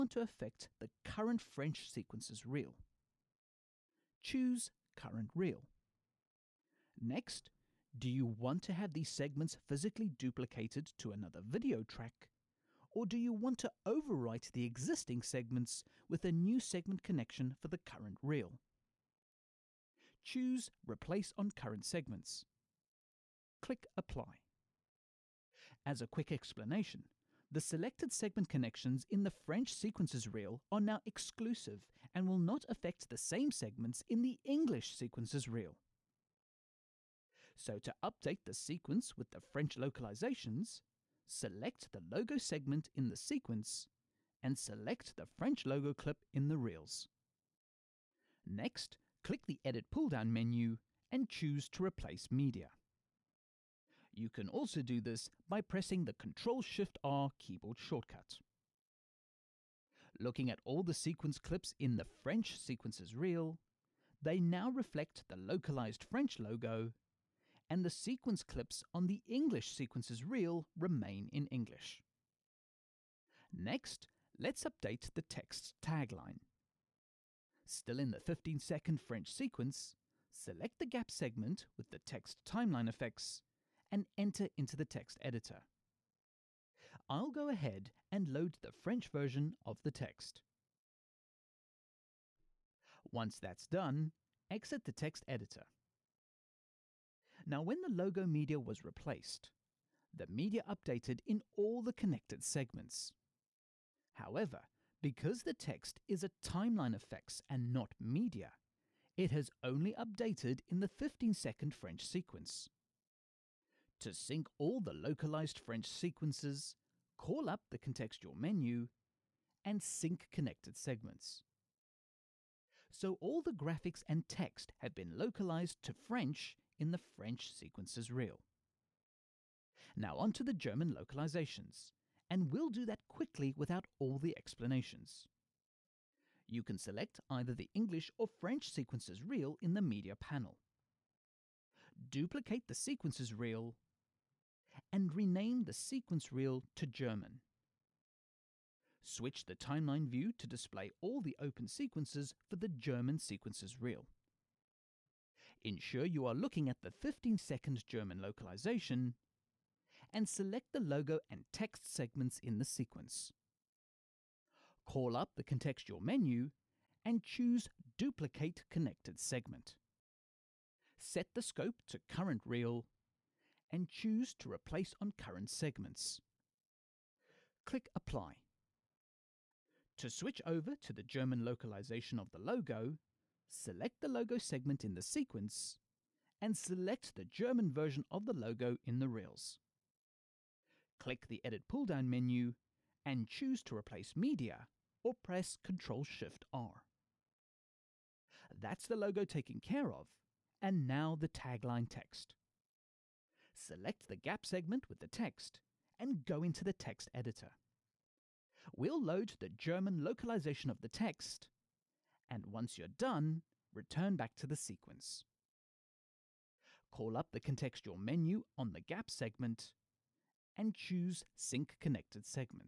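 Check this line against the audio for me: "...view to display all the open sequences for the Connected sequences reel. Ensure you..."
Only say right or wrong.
wrong.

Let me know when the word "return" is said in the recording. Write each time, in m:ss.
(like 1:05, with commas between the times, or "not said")
3:33.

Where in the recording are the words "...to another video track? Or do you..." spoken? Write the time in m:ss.
0:10.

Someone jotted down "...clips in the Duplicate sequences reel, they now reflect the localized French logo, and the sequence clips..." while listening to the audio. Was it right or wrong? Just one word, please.
wrong.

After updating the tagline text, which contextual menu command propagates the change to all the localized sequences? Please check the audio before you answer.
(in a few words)
Sync connected segments.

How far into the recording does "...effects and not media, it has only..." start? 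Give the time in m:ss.
1:46.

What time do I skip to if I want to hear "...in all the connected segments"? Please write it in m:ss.
1:41.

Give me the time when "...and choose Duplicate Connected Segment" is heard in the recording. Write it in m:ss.
2:47.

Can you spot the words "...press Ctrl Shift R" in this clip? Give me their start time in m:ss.
3:15.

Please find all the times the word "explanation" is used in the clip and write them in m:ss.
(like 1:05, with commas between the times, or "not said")
0:26, 2:14.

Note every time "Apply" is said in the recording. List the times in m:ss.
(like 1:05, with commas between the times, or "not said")
0:23, 2:57.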